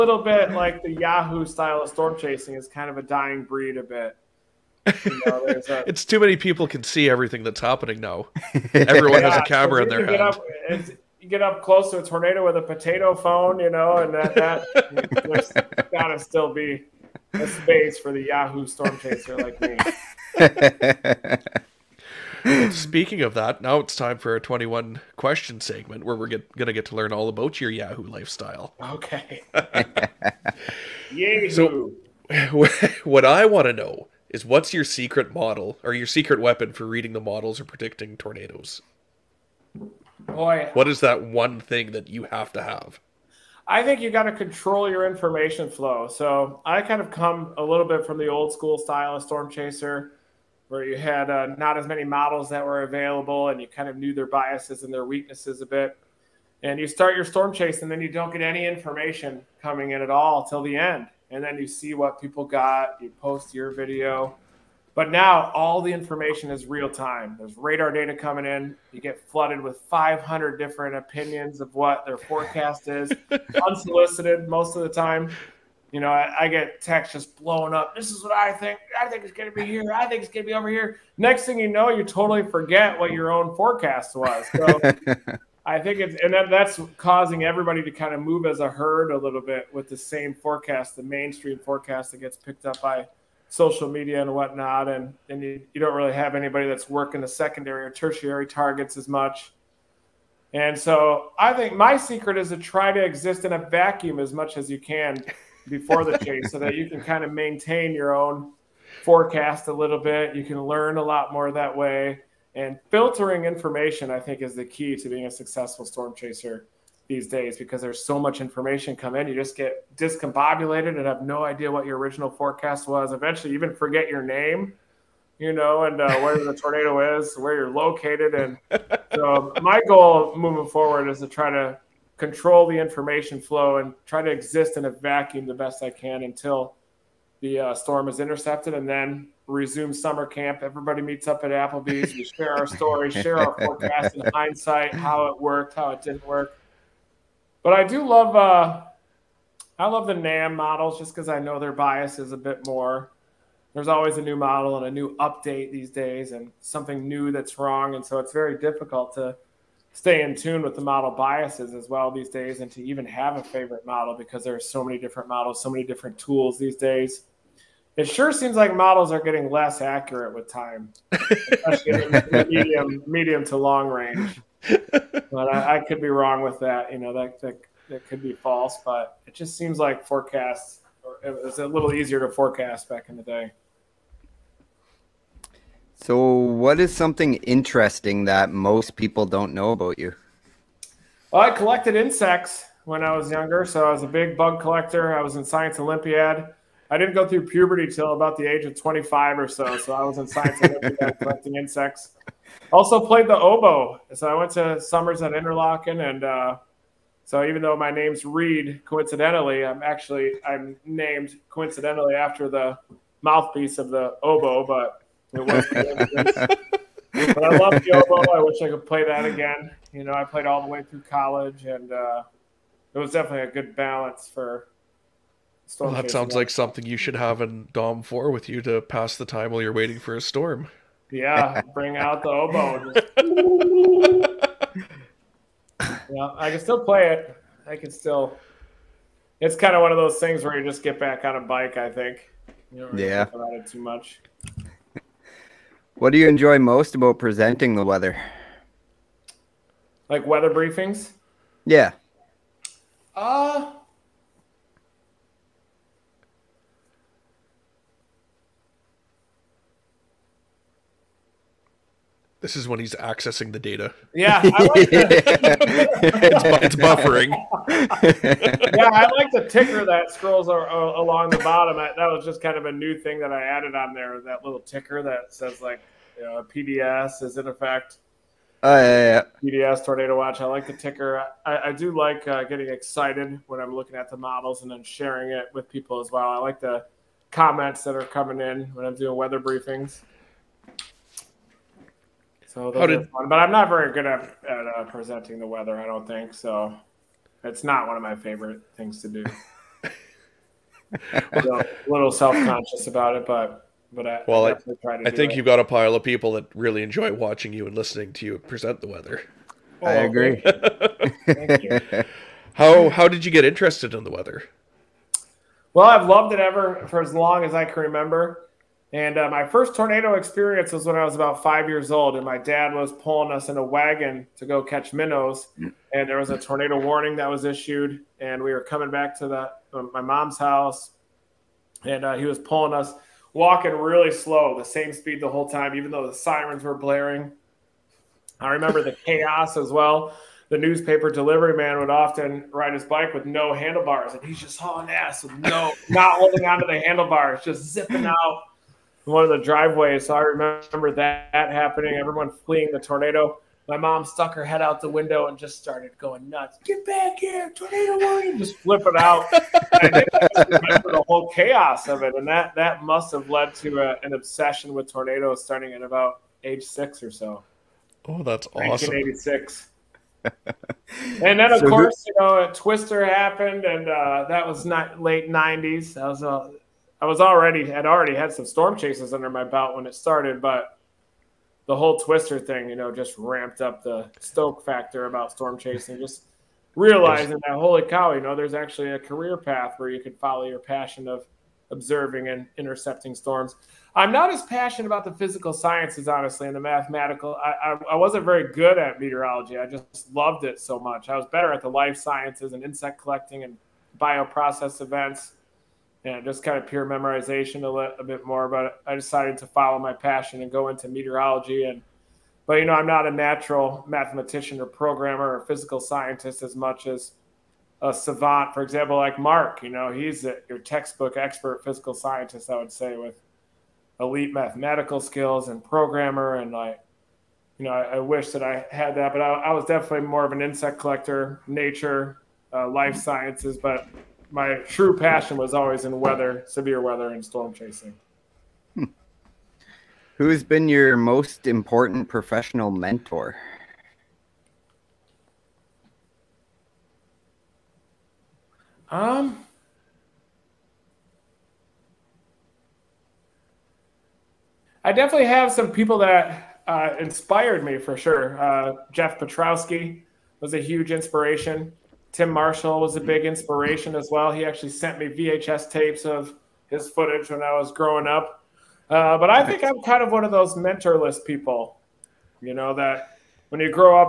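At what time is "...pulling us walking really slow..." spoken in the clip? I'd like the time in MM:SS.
05:32.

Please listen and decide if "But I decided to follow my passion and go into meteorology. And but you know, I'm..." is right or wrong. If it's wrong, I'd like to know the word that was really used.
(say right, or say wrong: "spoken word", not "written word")
right.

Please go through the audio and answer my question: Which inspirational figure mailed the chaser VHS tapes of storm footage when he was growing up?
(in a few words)
Tim Marshall.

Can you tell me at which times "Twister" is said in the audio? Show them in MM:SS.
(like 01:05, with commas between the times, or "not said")
06:12, 06:21.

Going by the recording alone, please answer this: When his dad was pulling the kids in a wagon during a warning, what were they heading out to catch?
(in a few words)
Minnows.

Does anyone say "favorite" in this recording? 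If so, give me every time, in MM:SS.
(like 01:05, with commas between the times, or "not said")
02:43, 04:58.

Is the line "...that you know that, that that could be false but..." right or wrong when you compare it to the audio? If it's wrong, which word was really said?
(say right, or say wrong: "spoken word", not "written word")
right.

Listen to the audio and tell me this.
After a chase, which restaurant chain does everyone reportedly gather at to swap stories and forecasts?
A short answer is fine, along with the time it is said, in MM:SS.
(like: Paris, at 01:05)
Applebee's, at 02:21.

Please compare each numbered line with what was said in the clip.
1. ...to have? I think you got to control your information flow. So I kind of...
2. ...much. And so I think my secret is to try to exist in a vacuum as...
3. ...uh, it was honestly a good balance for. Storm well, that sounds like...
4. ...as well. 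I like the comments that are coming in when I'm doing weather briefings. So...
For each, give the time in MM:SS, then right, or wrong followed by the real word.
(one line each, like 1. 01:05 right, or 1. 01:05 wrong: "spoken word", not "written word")
1. 00:42 right
2. 01:39 right
3. 03:41 wrong: "definitely", not "honestly"
4. 04:45 right.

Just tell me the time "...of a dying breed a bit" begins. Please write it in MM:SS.
00:02.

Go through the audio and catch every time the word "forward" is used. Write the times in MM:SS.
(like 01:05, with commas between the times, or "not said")
02:10.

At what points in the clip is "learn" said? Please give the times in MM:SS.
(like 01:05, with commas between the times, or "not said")
00:26, 01:50.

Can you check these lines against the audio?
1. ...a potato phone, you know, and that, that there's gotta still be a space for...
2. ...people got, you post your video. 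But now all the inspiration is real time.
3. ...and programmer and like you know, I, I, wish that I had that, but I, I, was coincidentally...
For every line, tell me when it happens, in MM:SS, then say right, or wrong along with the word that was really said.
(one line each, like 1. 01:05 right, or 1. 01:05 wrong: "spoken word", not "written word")
1. 00:12 right
2. 01:02 wrong: "information", not "inspiration"
3. 07:05 wrong: "definitely", not "coincidentally".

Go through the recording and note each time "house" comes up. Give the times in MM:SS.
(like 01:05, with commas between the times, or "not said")
05:30.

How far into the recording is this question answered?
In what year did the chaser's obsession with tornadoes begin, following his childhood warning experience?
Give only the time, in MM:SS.
06:08.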